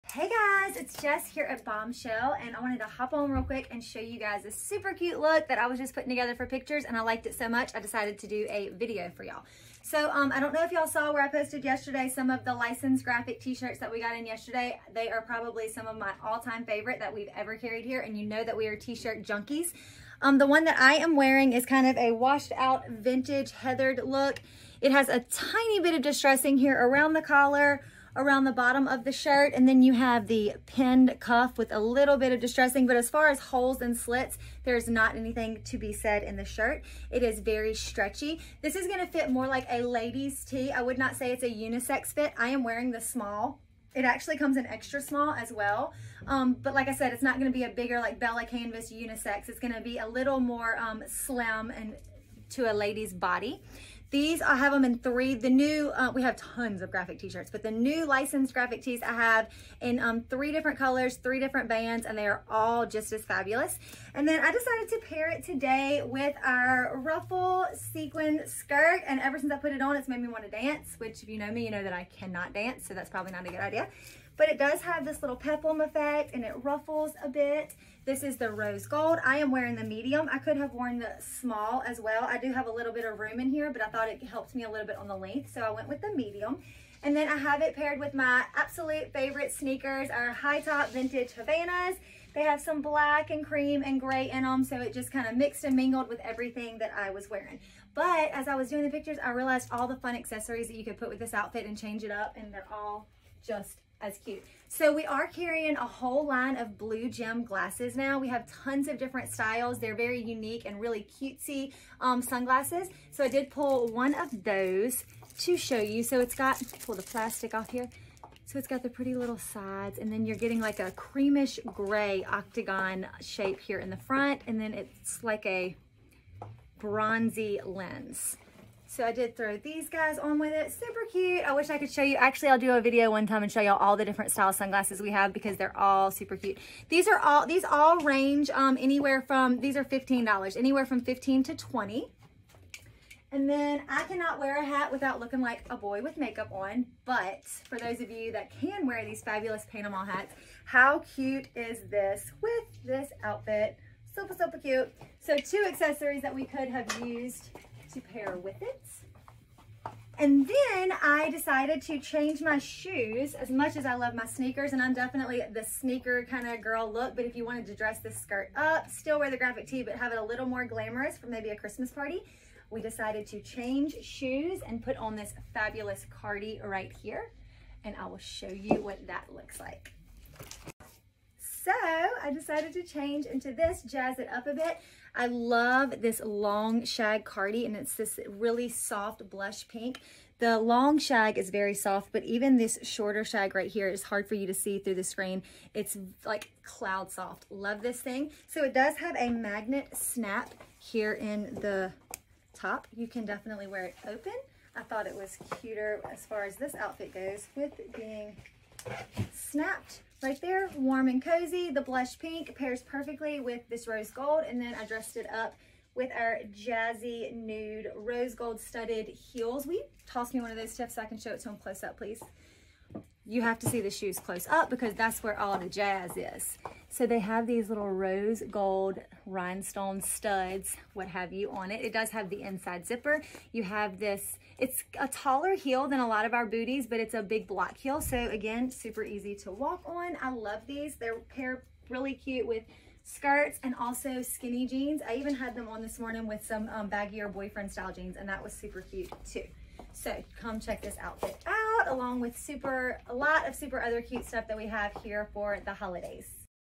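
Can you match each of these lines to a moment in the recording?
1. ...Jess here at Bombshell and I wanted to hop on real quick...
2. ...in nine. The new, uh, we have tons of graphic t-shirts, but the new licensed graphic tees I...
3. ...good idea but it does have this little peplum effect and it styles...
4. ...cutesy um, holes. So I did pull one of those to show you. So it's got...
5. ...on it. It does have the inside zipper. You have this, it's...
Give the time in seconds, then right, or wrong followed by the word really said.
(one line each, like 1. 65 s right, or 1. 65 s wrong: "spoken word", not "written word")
1. 1 s right
2. 54 s wrong: "three", not "nine"
3. 73 s wrong: "ruffles", not "styles"
4. 111 s wrong: "sunglasses", not "holes"
5. 231 s right.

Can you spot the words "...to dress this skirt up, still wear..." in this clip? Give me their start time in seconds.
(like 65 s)
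167 s.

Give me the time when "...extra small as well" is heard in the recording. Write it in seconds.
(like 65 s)
44 s.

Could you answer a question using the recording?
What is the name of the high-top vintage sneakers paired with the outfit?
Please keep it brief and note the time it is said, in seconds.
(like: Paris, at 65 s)
Havanas, at 91 s.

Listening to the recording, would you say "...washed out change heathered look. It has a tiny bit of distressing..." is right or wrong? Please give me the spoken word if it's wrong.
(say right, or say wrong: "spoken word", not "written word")
wrong: "vintage", not "change".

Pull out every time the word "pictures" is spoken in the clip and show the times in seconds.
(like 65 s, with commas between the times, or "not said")
6 s, 98 s.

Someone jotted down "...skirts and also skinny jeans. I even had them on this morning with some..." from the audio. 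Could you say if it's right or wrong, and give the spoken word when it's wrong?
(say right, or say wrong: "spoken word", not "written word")
right.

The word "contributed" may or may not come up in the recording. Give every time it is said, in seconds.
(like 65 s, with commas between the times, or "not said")
not said.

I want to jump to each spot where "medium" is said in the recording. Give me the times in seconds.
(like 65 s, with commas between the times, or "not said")
79 s, 86 s.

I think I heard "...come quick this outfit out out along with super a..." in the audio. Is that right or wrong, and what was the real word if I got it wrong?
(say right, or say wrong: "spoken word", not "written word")
wrong: "check", not "quick".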